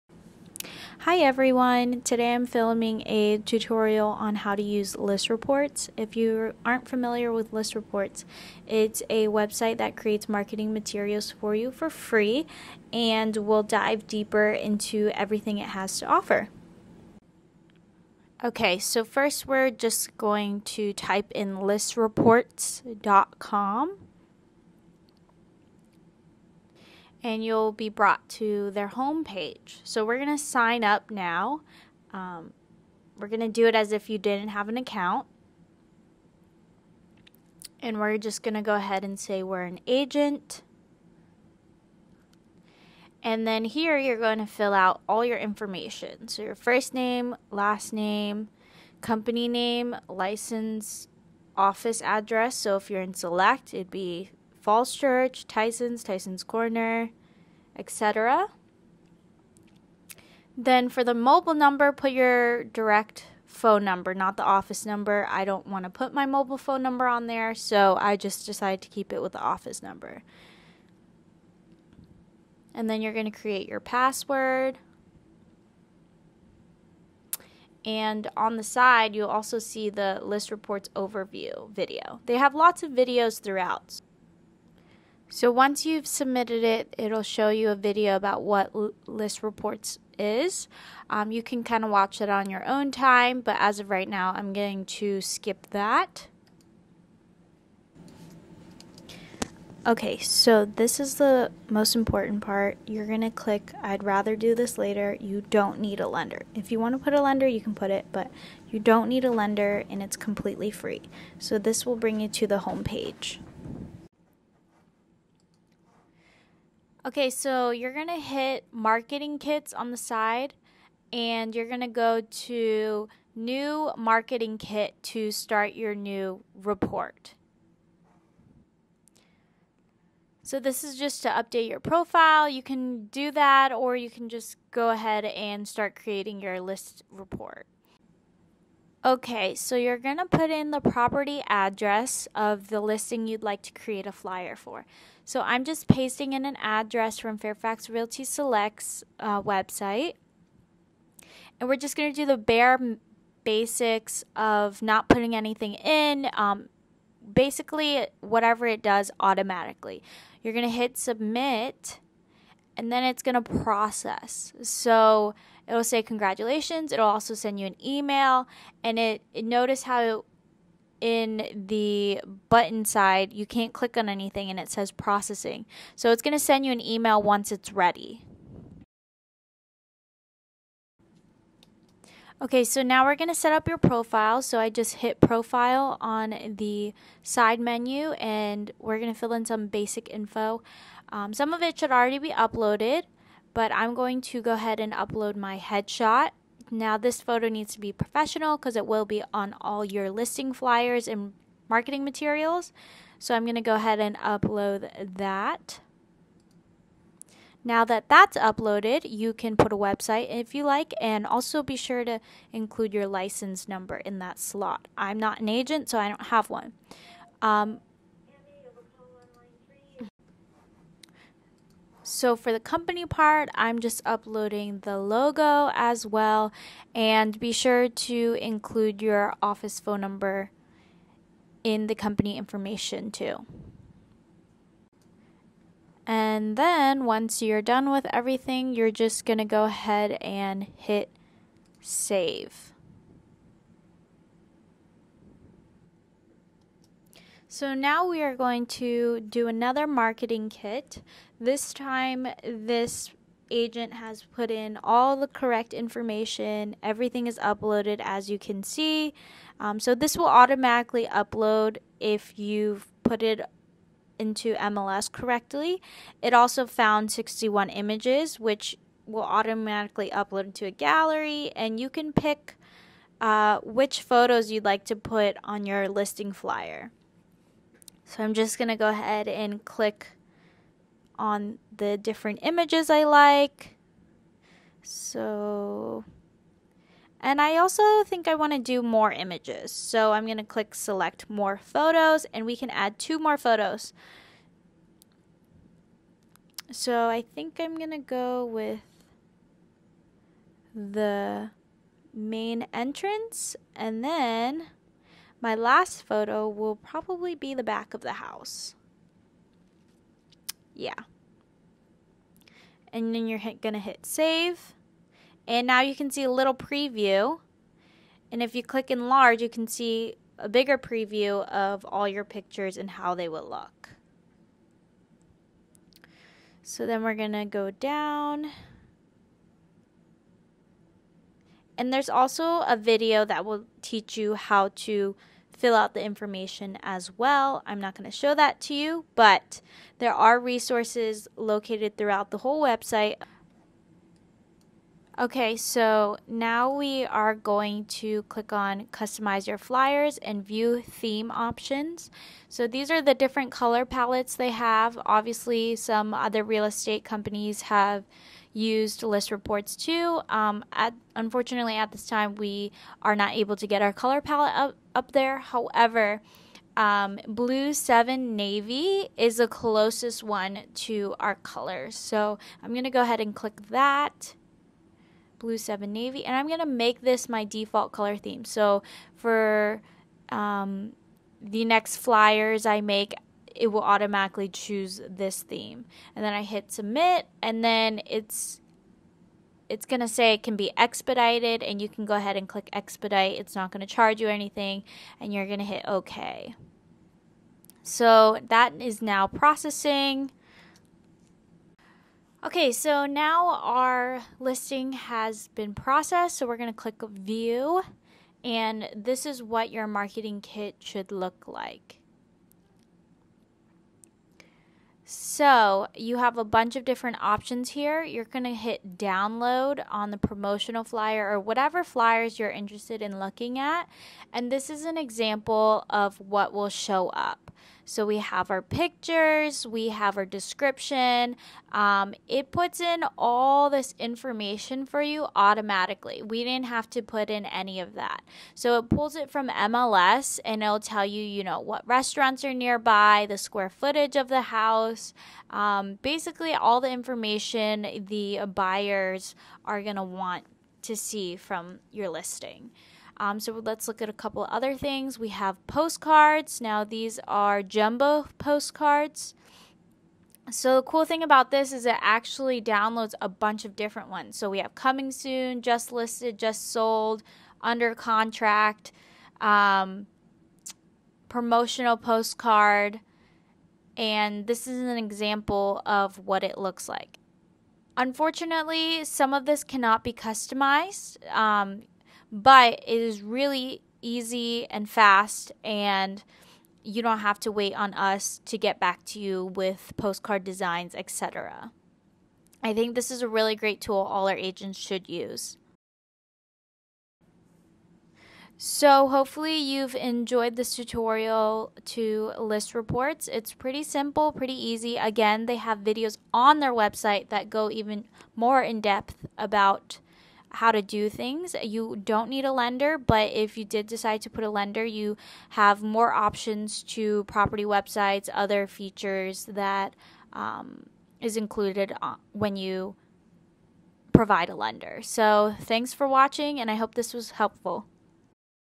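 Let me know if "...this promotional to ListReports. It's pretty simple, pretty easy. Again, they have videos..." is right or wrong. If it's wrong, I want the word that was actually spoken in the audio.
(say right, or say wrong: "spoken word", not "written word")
wrong: "tutorial", not "promotional".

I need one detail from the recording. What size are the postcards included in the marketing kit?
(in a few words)
jumbo.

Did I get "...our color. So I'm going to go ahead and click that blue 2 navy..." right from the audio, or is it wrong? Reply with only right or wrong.
wrong.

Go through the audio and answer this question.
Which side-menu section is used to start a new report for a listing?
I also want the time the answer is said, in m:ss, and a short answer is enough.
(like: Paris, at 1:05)
marketing kits, at 1:58.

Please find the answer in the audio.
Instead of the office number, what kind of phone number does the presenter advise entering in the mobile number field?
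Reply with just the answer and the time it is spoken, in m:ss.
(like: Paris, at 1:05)
direct phone number, at 1:02.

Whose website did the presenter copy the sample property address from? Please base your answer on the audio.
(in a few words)
Fairfax Realty Select.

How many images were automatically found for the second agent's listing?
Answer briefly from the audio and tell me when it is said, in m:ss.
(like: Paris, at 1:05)
61, at 4:27.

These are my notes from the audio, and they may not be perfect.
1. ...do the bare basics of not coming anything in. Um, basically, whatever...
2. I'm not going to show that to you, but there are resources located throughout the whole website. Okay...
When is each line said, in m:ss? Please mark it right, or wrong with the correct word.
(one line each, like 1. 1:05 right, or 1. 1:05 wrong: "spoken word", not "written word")
1. 2:32 wrong: "putting", not "coming"
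2. 5:37 right.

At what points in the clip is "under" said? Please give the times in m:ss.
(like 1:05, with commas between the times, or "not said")
7:47.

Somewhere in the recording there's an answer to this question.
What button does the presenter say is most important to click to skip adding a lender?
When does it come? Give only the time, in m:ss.
1:43.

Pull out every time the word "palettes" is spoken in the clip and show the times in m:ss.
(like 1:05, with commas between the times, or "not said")
5:53, 6:04.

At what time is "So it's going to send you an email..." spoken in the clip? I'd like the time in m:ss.
2:55.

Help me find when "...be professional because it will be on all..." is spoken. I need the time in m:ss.
3:17.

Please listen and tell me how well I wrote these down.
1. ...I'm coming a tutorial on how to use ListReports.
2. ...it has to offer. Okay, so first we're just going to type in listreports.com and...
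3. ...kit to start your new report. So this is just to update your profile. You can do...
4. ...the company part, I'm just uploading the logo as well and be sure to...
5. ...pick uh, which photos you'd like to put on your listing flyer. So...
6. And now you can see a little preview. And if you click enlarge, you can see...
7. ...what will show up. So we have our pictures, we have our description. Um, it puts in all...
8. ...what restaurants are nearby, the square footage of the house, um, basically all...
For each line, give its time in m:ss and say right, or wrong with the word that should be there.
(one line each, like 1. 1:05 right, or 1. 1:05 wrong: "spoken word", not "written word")
1. 0:02 wrong: "filming", not "coming"
2. 0:15 right
3. 2:04 right
4. 3:42 right
5. 4:32 right
6. 5:15 right
7. 7:06 right
8. 7:21 right.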